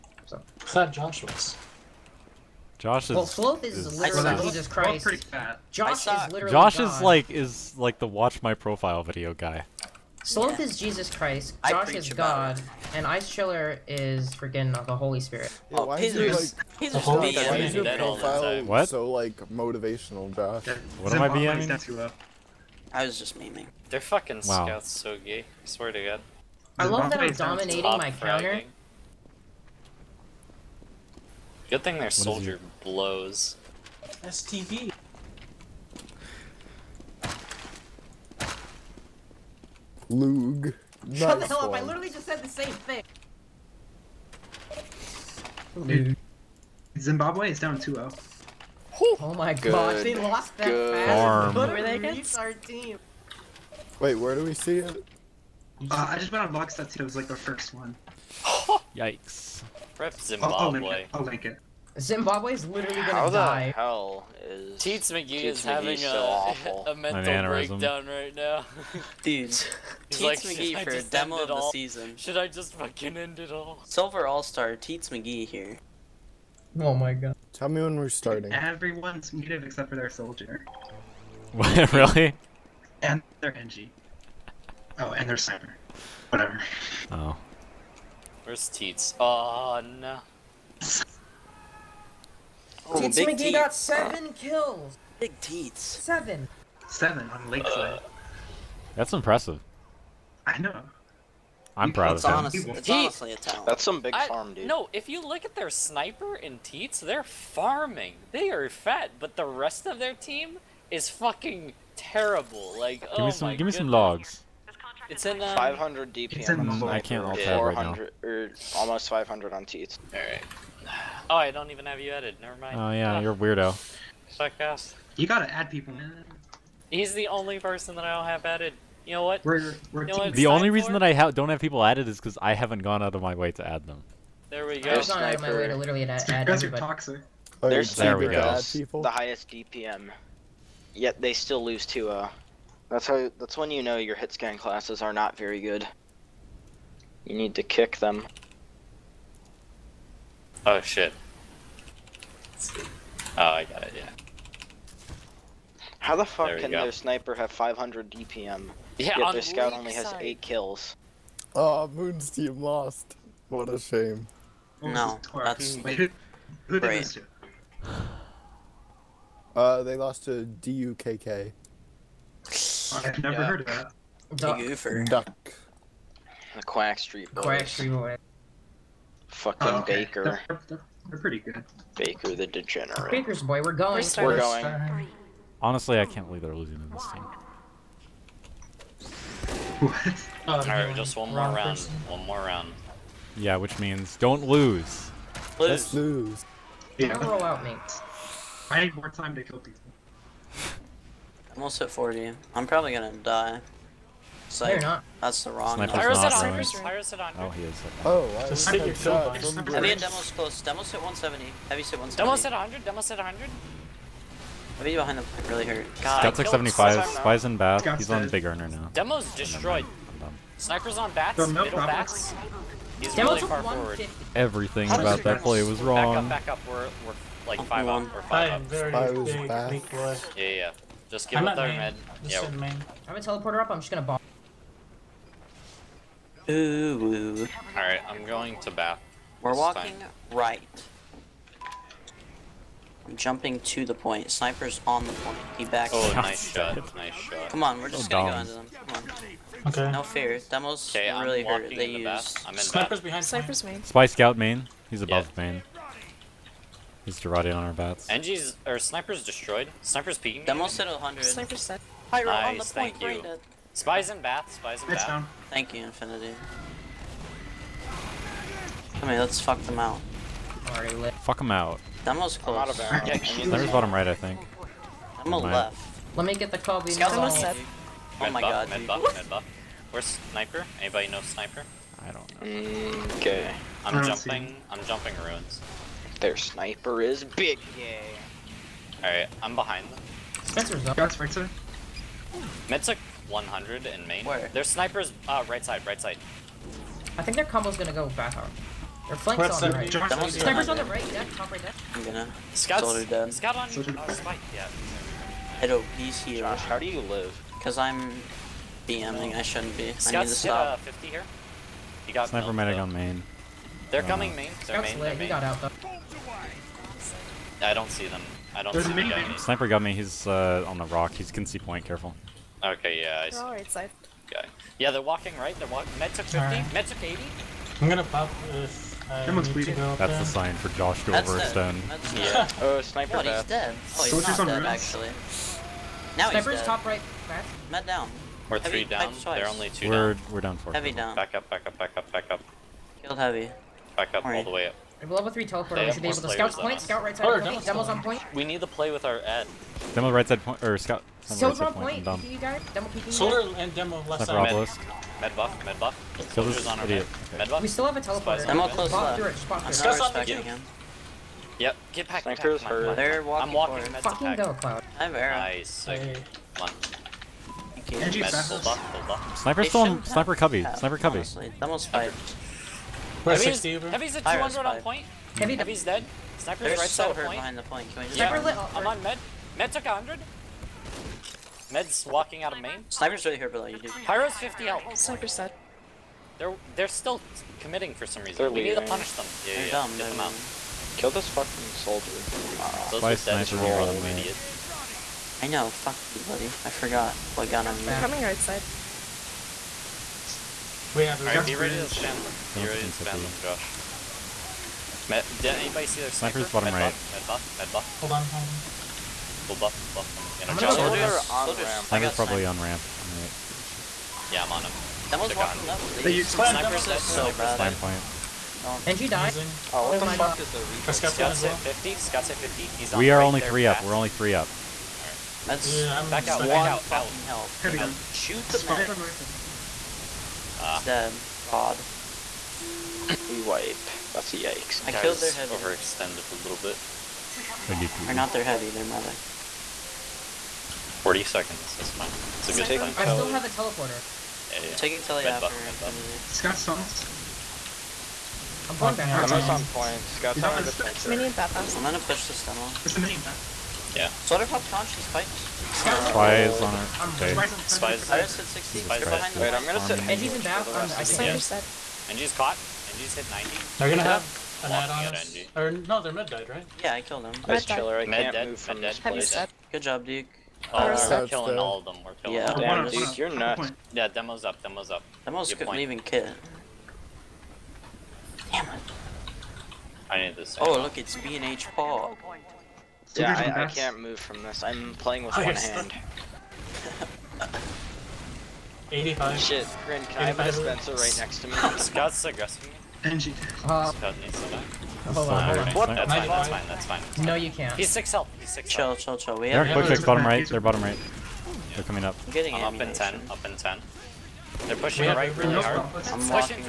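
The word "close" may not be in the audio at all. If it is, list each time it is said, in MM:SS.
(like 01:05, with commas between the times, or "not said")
03:30, 04:32, 05:58.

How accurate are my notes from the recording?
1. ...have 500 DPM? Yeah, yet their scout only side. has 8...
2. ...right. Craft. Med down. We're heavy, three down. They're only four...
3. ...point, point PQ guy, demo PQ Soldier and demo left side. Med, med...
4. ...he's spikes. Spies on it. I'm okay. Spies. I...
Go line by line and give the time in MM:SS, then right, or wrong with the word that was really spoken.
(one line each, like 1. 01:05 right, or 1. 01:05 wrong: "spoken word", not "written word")
1. 02:37 right
2. 05:36 wrong: "two", not "four"
3. 05:51 right
4. 07:34 right.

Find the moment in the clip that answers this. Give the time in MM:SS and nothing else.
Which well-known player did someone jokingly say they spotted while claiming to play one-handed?
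08:01.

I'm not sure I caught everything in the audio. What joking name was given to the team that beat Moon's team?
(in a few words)
The Quack Street Boys.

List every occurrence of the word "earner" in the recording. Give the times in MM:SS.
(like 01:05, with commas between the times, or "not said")
03:38.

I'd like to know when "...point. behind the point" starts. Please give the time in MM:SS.
06:17.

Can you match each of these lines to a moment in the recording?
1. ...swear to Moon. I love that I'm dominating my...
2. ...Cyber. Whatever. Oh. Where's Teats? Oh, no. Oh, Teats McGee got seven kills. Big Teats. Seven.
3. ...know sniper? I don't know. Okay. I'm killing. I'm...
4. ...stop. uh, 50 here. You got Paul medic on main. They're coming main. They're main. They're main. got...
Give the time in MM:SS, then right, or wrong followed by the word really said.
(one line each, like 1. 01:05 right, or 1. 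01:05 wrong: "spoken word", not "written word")
1. 00:25 wrong: "God", not "Moon"
2. 01:25 right
3. 04:41 wrong: "jumping", not "killing"
4. 05:10 wrong: "Sniper", not "Paul".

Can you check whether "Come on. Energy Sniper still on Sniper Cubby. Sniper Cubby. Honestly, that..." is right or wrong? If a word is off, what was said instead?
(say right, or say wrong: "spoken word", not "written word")
right.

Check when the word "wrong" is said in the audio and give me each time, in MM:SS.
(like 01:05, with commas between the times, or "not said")
03:25, 03:45.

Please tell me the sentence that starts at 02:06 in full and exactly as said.
He's the only person that I don't have added.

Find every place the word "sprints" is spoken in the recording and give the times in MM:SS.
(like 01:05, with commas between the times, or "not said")
not said.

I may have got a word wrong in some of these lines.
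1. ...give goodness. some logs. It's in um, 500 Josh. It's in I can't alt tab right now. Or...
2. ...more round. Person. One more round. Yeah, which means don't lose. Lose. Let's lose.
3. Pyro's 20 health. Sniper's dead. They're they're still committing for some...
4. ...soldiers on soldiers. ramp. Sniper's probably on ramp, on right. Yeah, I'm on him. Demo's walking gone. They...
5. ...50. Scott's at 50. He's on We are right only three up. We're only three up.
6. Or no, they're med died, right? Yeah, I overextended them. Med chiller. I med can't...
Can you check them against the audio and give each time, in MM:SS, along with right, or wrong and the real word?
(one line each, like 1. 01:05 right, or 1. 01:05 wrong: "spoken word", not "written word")
1. 01:53 wrong: "DPM", not "Josh"
2. 03:11 right
3. 06:24 wrong: "50", not "20"
4. 06:51 right
5. 07:01 right
6. 07:45 wrong: "killed", not "overextended".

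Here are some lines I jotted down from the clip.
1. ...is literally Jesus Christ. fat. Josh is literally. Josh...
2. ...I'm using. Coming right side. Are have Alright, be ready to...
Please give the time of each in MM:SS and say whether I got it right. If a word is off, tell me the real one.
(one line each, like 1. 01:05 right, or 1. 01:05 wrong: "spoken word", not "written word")
1. 00:03 right
2. 06:37 right.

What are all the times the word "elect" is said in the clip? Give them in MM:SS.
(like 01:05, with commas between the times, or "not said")
not said.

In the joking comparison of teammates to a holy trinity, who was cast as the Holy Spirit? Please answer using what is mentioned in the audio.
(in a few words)
Ice Chiller.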